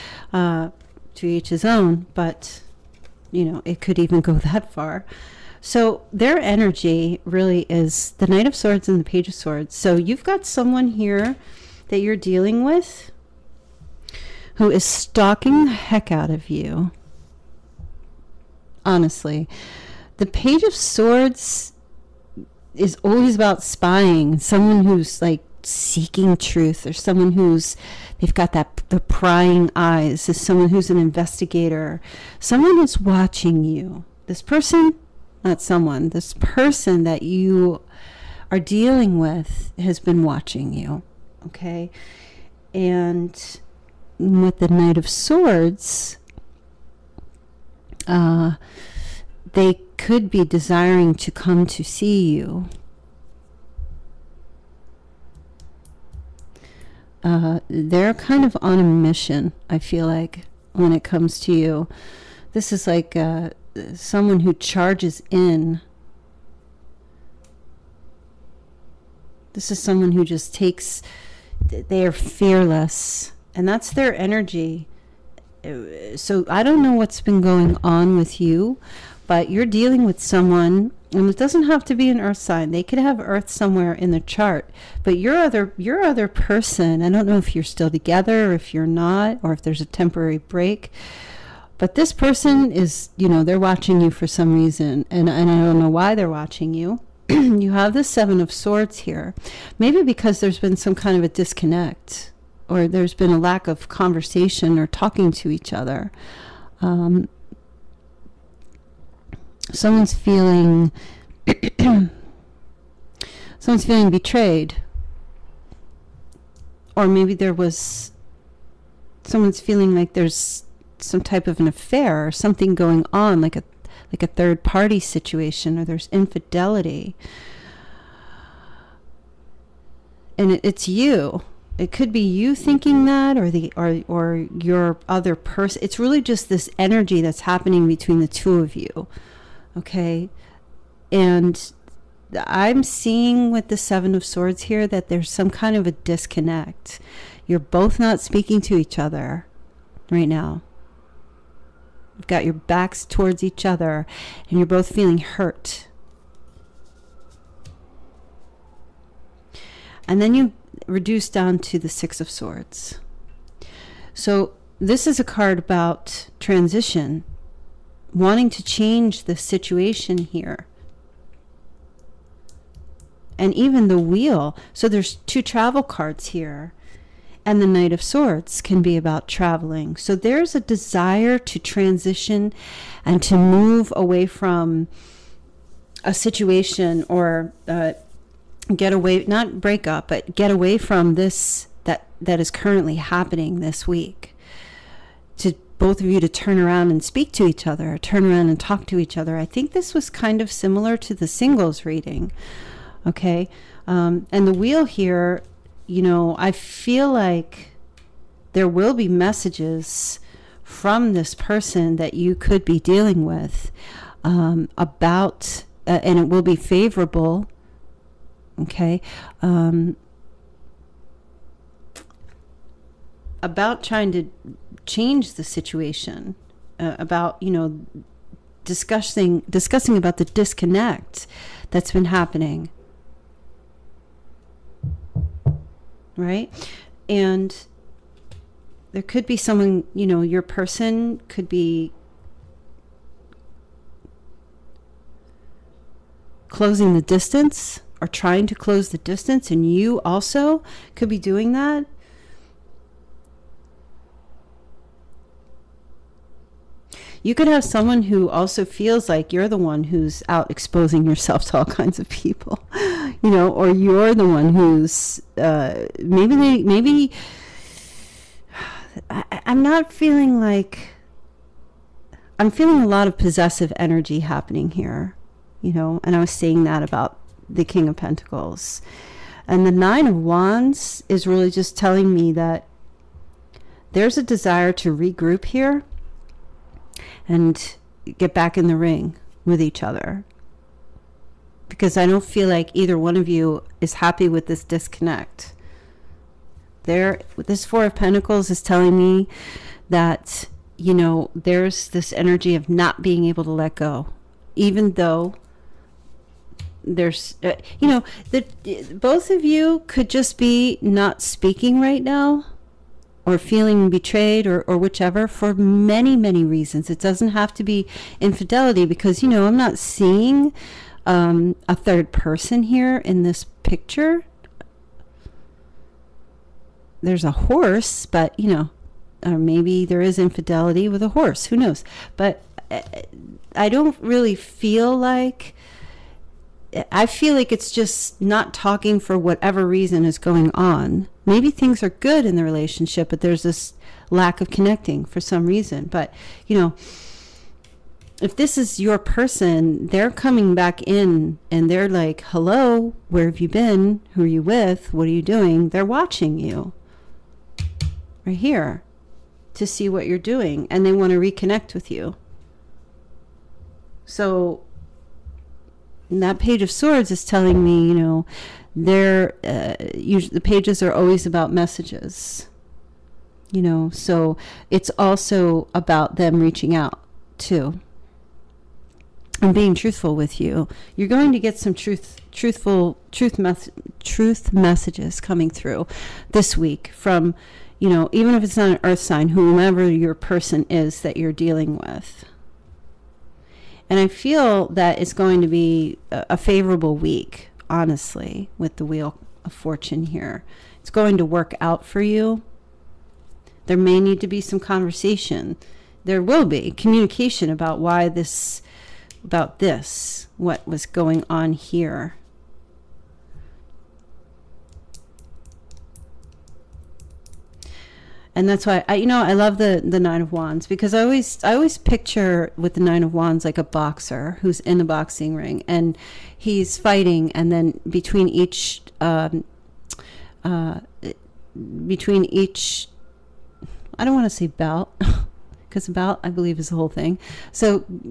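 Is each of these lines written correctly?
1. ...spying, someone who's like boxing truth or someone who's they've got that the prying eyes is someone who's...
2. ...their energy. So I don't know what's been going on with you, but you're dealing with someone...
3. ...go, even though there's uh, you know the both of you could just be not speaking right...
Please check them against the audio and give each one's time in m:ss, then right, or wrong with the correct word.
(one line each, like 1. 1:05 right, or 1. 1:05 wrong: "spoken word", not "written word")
1. 0:23 wrong: "seeking", not "boxing"
2. 1:13 right
3. 5:03 right.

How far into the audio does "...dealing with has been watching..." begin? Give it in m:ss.
0:38.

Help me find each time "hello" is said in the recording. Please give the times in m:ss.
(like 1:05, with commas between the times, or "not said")
5:52.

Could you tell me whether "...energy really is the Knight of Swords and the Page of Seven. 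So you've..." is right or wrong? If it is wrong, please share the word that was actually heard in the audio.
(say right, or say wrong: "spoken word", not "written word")
wrong: "Swords", not "Seven".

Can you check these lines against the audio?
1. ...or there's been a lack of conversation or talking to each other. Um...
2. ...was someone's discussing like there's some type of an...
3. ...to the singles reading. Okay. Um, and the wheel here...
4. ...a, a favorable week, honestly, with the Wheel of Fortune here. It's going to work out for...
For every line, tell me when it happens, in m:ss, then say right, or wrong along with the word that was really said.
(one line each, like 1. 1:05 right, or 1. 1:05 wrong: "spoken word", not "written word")
1. 1:42 right
2. 1:57 wrong: "feeling", not "discussing"
3. 3:20 right
4. 6:36 right.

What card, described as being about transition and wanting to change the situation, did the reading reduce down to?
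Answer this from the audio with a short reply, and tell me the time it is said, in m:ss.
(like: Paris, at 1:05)
Six of Swords, at 2:41.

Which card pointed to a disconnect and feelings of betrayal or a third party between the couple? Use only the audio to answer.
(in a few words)
Seven of Swords.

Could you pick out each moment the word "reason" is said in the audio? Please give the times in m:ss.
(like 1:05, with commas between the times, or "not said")
1:34, 5:16, 5:39, 5:45.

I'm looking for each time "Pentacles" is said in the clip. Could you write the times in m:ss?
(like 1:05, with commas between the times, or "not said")
4:37, 4:57.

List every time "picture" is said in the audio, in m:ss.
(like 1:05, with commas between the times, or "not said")
5:23, 7:01.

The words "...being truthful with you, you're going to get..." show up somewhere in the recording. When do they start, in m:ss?
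6:19.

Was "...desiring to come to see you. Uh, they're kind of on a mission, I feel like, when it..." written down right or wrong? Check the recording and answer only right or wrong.
right.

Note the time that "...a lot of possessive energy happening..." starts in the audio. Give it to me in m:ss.
4:32.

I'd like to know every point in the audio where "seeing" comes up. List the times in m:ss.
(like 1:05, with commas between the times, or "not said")
2:22, 5:19.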